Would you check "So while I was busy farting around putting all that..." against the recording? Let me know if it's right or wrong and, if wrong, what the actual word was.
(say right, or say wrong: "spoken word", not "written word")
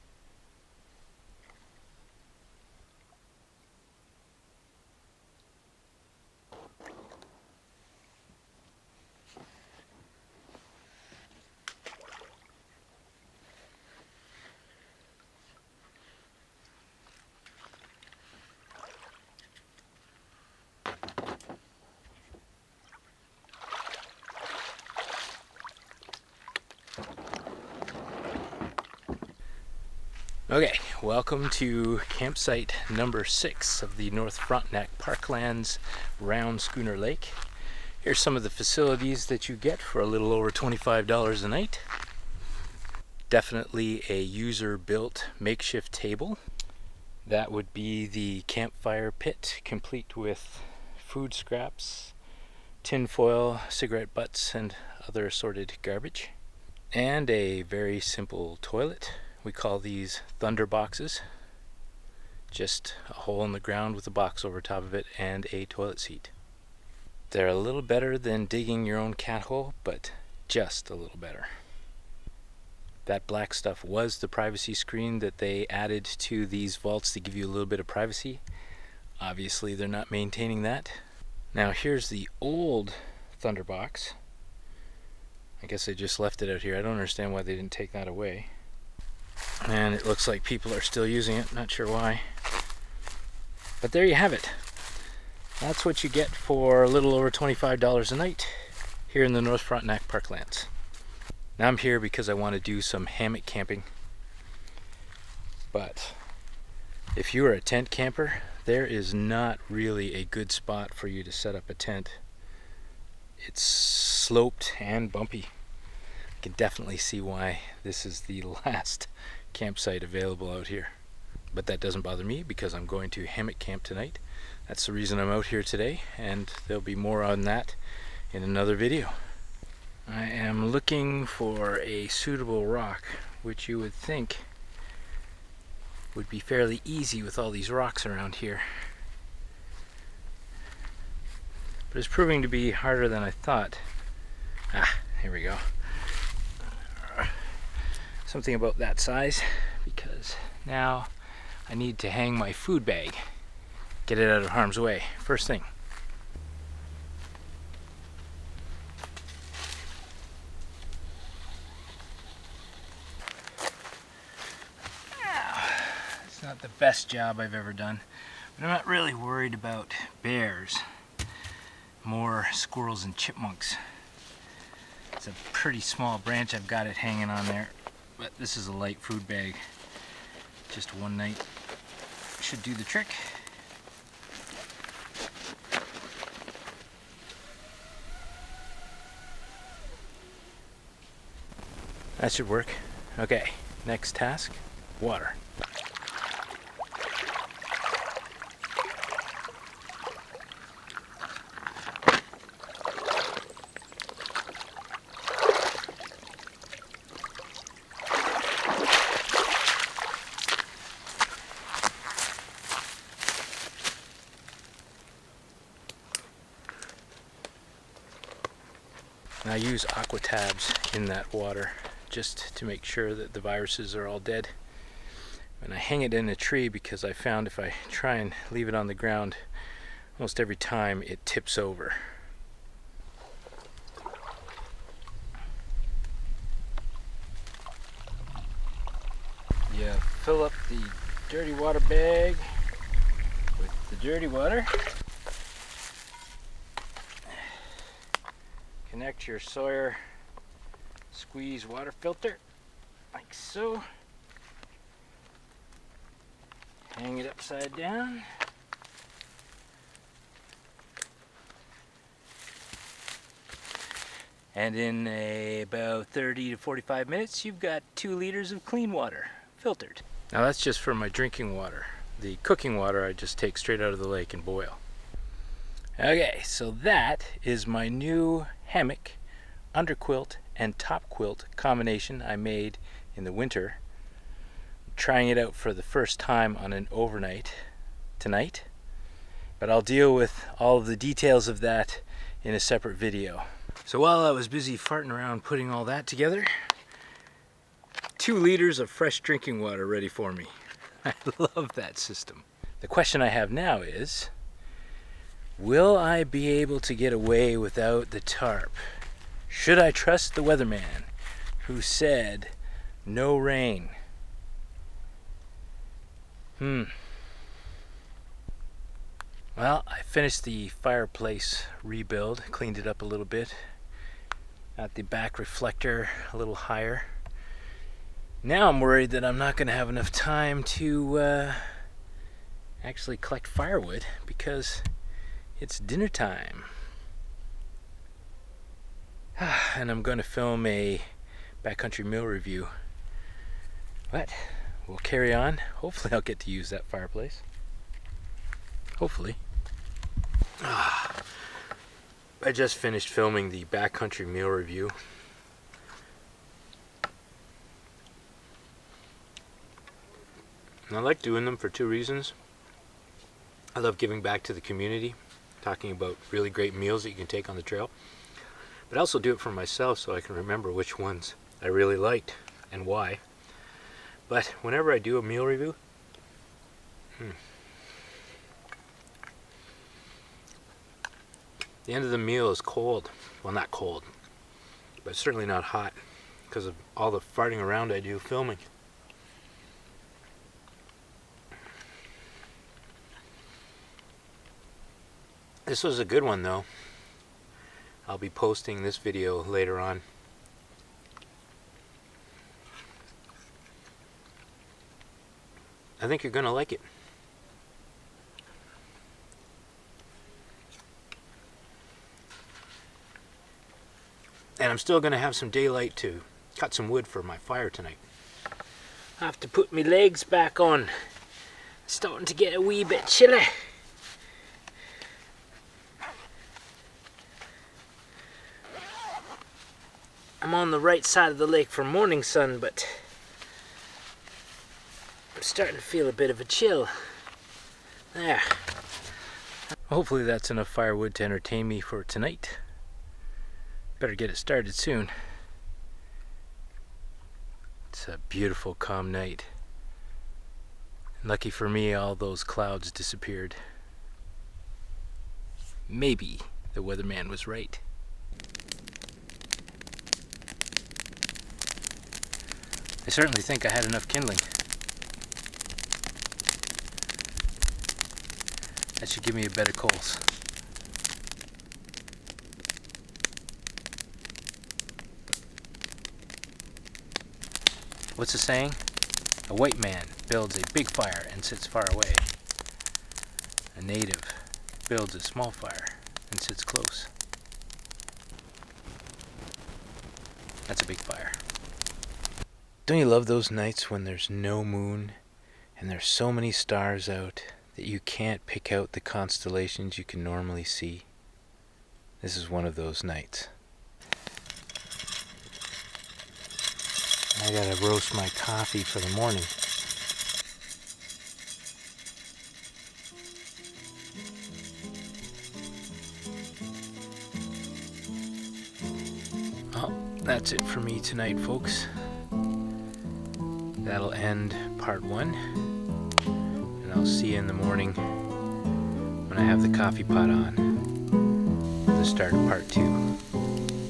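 right.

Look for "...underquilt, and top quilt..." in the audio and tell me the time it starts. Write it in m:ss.
4:39.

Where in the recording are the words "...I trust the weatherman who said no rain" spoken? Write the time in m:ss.
5:09.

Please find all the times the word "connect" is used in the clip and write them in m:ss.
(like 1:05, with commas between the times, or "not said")
4:09.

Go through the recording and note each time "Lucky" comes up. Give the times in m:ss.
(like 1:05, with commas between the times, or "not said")
7:31.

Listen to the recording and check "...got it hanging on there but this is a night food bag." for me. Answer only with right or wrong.
wrong.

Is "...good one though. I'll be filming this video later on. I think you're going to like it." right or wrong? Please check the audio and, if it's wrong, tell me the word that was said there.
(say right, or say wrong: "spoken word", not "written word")
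wrong: "posting", not "filming".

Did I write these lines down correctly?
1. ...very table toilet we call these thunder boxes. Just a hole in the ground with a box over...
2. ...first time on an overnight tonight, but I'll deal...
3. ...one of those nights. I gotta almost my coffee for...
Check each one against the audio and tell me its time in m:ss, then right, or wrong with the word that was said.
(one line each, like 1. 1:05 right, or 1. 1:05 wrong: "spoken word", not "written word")
1. 0:57 wrong: "simple", not "table"
2. 4:45 right
3. 8:22 wrong: "roast", not "almost".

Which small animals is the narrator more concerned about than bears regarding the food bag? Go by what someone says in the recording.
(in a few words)
Squirrels and chipmunks.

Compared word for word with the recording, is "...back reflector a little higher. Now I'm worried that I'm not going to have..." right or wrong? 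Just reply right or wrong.
right.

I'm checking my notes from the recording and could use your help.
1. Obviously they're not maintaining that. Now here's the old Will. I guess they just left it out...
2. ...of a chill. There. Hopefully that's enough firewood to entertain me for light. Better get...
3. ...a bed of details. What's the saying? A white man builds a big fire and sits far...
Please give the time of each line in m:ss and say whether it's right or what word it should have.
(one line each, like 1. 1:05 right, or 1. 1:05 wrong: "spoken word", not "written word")
1. 1:19 wrong: "Thunderbox", not "Will"
2. 7:16 wrong: "tonight", not "light"
3. 7:49 wrong: "coals", not "details".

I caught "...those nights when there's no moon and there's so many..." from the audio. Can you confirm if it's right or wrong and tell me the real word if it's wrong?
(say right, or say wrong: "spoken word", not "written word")
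right.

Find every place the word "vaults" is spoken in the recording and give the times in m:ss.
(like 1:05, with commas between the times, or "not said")
1:16.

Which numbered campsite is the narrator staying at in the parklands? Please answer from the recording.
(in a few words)
6.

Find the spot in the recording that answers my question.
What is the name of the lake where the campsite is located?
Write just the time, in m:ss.
0:36.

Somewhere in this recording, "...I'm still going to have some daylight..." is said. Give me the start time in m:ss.
6:54.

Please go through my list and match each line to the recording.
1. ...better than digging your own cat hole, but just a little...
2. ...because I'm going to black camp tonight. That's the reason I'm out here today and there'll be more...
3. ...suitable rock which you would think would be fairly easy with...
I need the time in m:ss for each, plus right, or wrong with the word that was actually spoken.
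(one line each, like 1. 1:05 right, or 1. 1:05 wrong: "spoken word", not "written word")
1. 1:07 right
2. 2:02 wrong: "hammock", not "black"
3. 2:12 right.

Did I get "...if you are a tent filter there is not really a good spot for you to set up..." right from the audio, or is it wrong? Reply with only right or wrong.
wrong.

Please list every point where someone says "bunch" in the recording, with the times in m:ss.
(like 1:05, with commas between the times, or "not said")
not said.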